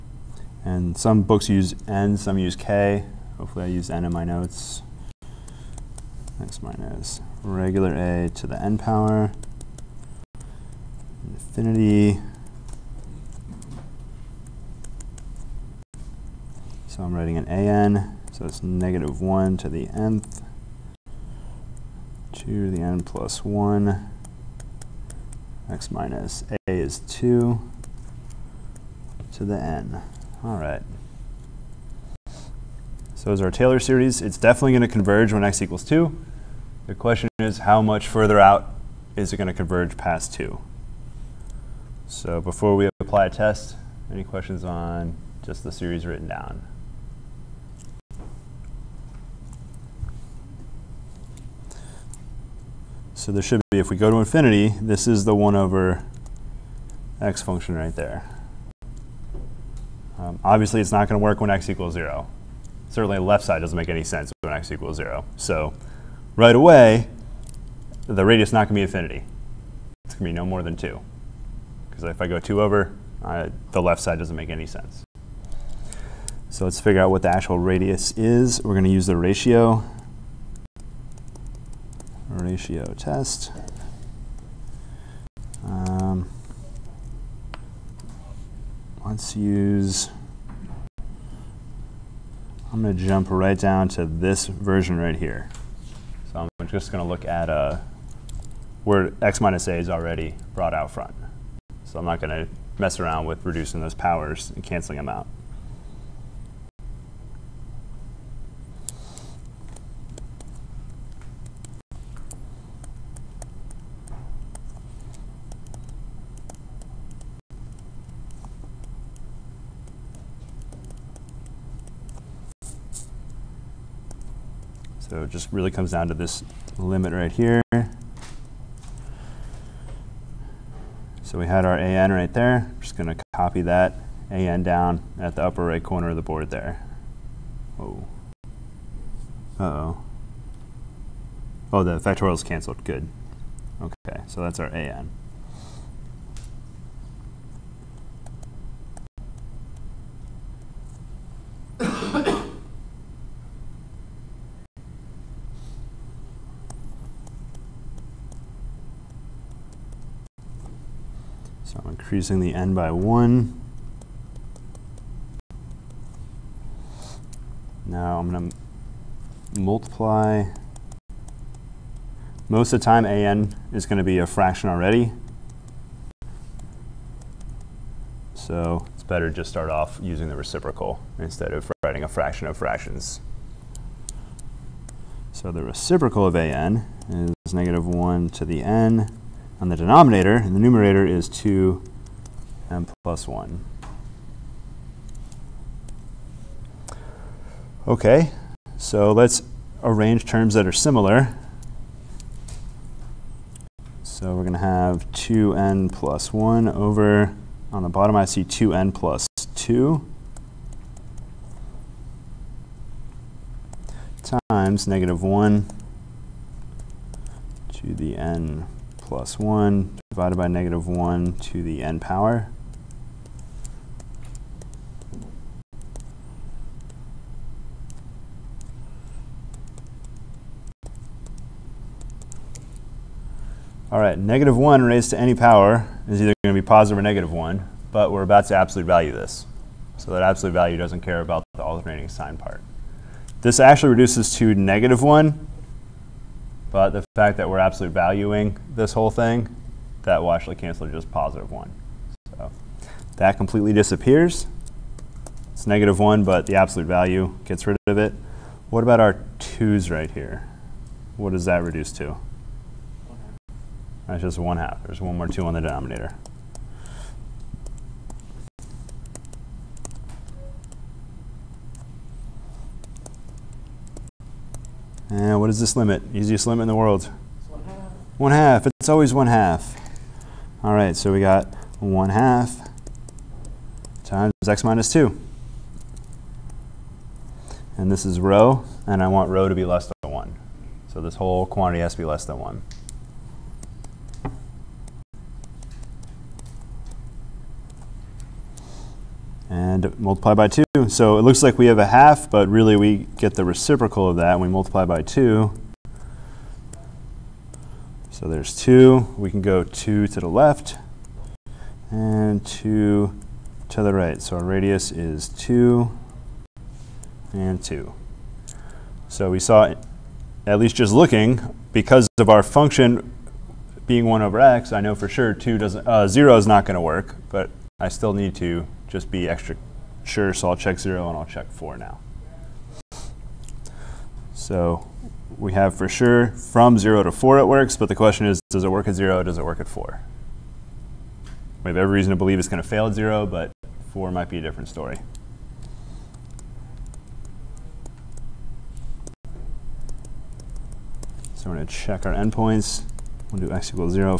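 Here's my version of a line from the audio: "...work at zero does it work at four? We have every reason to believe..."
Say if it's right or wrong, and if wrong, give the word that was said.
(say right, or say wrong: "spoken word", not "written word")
right.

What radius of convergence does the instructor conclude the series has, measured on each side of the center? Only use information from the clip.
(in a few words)
2.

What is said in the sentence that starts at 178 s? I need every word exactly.
So it's better to just start off using the reciprocal instead of writing a fraction of fractions.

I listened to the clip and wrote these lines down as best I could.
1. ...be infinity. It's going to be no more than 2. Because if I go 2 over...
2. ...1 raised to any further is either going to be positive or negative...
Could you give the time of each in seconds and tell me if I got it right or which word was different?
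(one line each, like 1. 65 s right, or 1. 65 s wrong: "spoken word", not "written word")
1. 68 s right
2. 234 s wrong: "power", not "further".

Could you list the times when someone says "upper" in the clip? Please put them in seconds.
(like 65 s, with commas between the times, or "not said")
135 s.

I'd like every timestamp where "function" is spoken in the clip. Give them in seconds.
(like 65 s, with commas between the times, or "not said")
57 s, 322 s.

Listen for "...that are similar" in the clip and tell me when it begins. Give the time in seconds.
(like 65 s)
200 s.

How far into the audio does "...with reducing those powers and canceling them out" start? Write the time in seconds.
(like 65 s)
103 s.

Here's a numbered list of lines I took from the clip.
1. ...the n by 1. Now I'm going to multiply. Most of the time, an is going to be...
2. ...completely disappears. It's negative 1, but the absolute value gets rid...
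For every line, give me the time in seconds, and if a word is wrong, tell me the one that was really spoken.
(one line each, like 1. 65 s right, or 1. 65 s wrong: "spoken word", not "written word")
1. 162 s right
2. 253 s right.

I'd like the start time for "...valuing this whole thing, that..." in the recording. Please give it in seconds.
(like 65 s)
247 s.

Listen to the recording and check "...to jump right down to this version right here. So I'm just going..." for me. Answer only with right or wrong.
right.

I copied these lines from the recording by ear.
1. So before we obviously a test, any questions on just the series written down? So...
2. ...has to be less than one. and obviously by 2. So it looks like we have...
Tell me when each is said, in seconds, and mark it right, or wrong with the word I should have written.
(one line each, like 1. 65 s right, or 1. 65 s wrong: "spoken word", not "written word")
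1. 42 s wrong: "apply", not "obviously"
2. 291 s wrong: "multiply", not "obviously".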